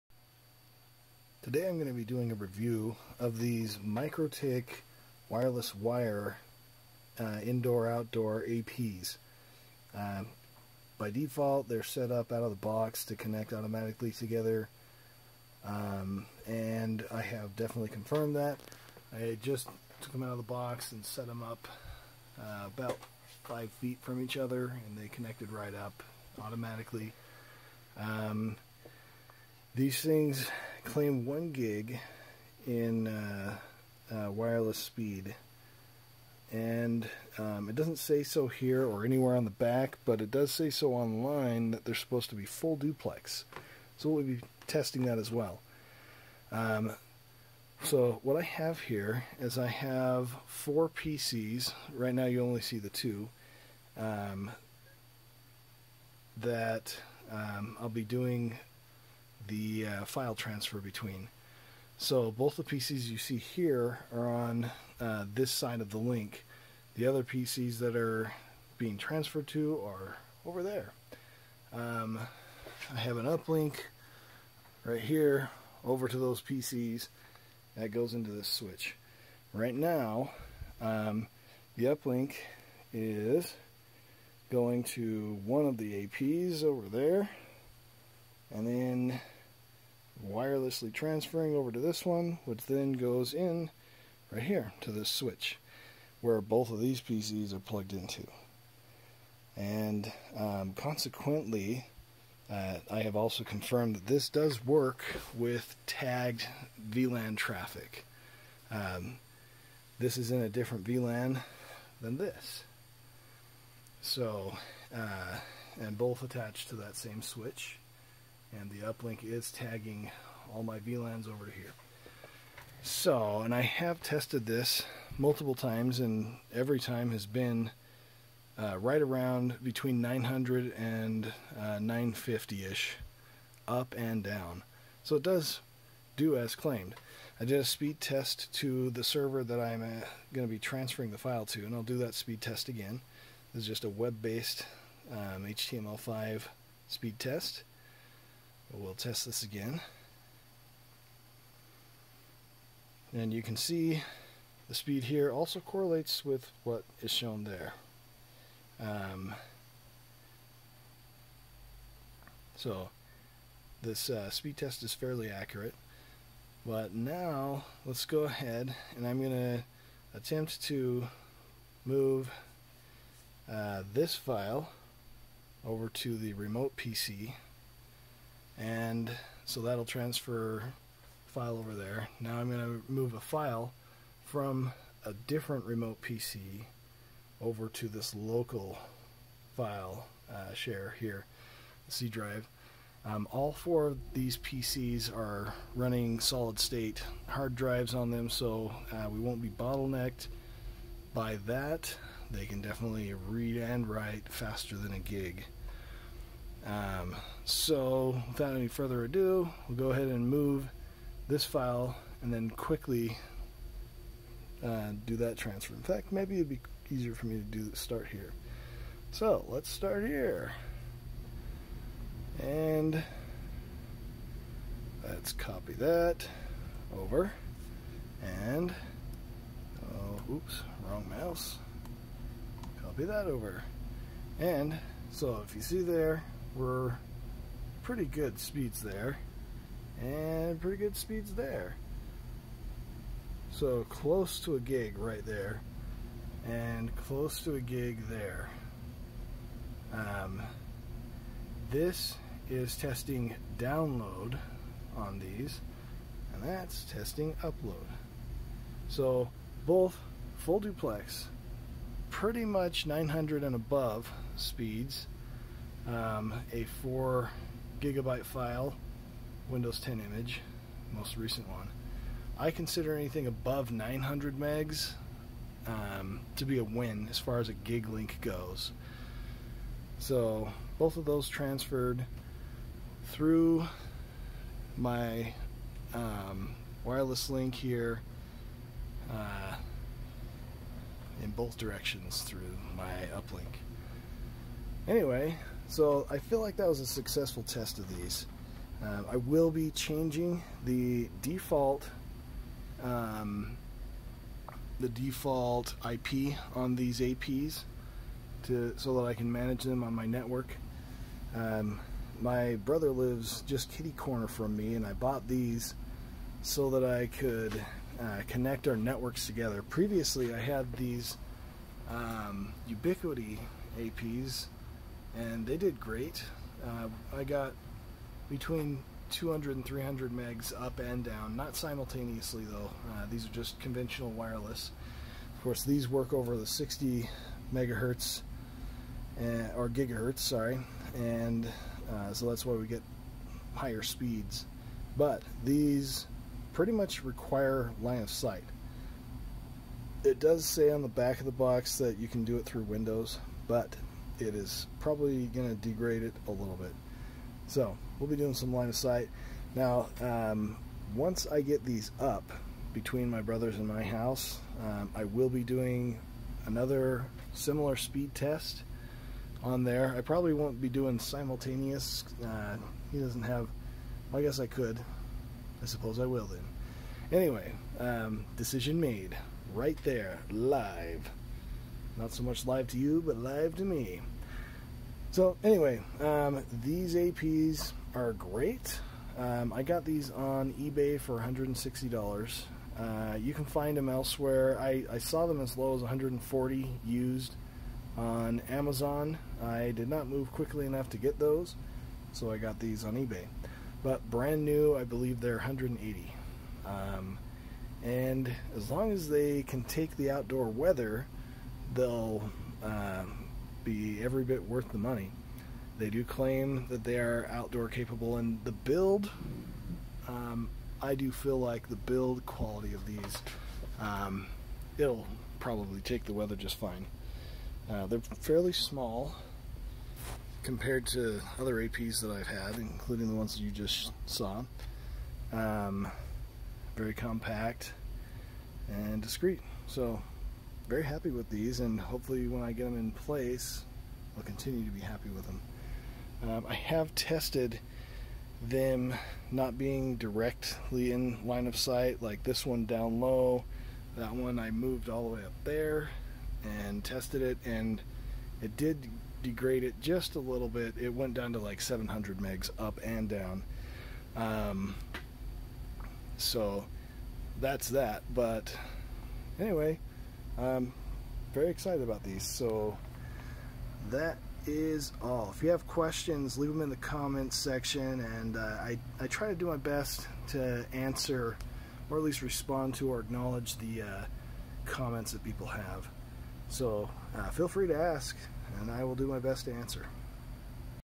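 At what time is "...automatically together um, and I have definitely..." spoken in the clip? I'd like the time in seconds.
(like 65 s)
13 s.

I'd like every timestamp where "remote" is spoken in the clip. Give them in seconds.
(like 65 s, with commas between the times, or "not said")
176 s, 185 s.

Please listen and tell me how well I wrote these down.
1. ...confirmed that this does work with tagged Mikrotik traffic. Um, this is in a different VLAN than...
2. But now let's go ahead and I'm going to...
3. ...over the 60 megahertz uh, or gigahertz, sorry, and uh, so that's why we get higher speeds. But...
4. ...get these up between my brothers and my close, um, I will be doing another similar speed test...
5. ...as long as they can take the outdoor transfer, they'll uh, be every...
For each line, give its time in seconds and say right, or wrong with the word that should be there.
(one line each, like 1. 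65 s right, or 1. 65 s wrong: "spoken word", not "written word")
1. 103 s wrong: "VLAN", not "Mikrotik"
2. 166 s right
3. 336 s right
4. 361 s wrong: "house", not "close"
5. 408 s wrong: "weather", not "transfer".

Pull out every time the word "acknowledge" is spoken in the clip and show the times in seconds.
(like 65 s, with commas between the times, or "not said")
483 s.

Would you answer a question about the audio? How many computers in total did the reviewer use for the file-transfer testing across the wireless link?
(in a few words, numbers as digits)
4.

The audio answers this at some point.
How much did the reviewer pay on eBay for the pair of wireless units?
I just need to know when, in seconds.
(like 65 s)
391 s.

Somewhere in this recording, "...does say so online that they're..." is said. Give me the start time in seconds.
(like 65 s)
40 s.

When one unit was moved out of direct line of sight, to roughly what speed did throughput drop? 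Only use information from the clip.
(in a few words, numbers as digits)
700 megs.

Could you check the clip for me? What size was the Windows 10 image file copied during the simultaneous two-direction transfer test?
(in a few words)
4 gigabytes.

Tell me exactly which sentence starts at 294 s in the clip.
Anyway, so I feel like that was a successful test of these.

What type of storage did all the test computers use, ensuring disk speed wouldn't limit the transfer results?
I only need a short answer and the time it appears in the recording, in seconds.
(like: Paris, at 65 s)
solid state, at 196 s.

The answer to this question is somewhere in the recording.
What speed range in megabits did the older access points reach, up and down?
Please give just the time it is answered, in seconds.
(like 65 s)
329 s.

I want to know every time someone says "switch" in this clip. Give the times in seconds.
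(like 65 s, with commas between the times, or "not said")
78 s, 95 s, 117 s.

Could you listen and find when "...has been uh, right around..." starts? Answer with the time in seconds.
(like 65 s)
127 s.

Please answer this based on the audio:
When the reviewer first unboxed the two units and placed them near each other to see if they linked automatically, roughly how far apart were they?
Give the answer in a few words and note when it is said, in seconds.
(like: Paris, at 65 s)
5 feet, at 23 s.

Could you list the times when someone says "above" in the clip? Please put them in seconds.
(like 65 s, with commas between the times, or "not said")
263 s, 273 s.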